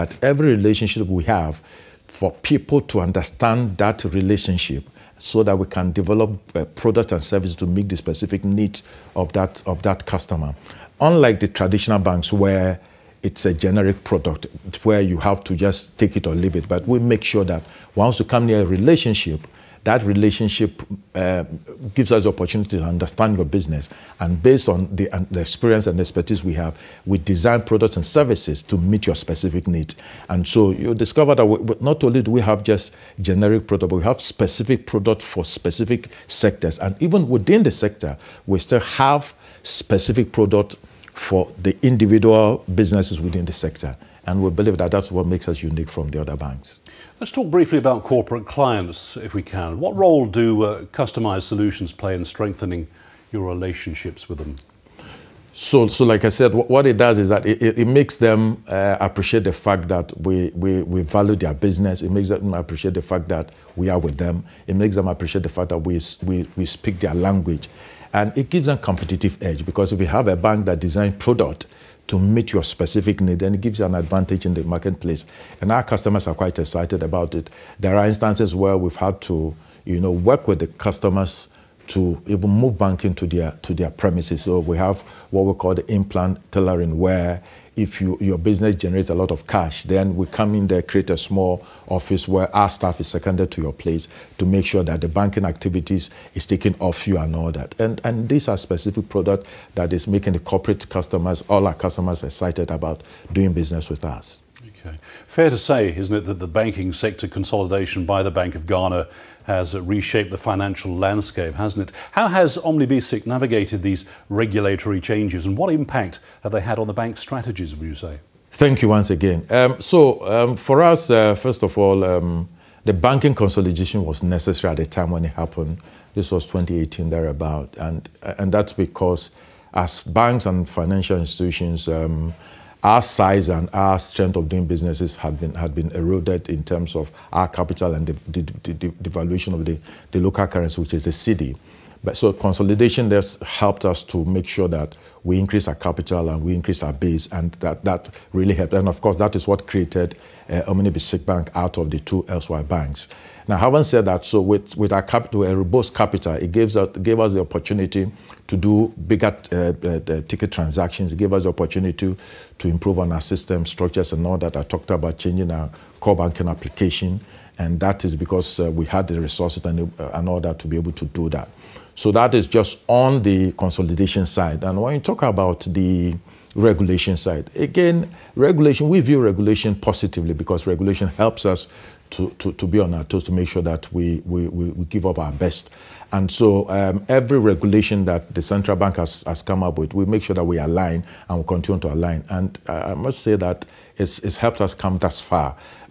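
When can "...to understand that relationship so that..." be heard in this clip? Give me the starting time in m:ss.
0:02.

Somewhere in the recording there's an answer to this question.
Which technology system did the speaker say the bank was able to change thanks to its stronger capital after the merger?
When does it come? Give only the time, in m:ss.
2:45.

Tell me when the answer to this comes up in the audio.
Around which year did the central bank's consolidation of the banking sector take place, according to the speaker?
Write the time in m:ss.
2:06.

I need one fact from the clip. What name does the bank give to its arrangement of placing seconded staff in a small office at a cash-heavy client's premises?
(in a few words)
implant tailoring.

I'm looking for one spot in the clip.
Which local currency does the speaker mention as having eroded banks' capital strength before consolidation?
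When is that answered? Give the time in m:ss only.
2:21.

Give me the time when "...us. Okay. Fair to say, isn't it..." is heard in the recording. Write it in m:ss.
1:44.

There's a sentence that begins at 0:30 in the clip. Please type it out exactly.
And so you discover that we, not only do we have just generic product, but we have specific product for specific sectors.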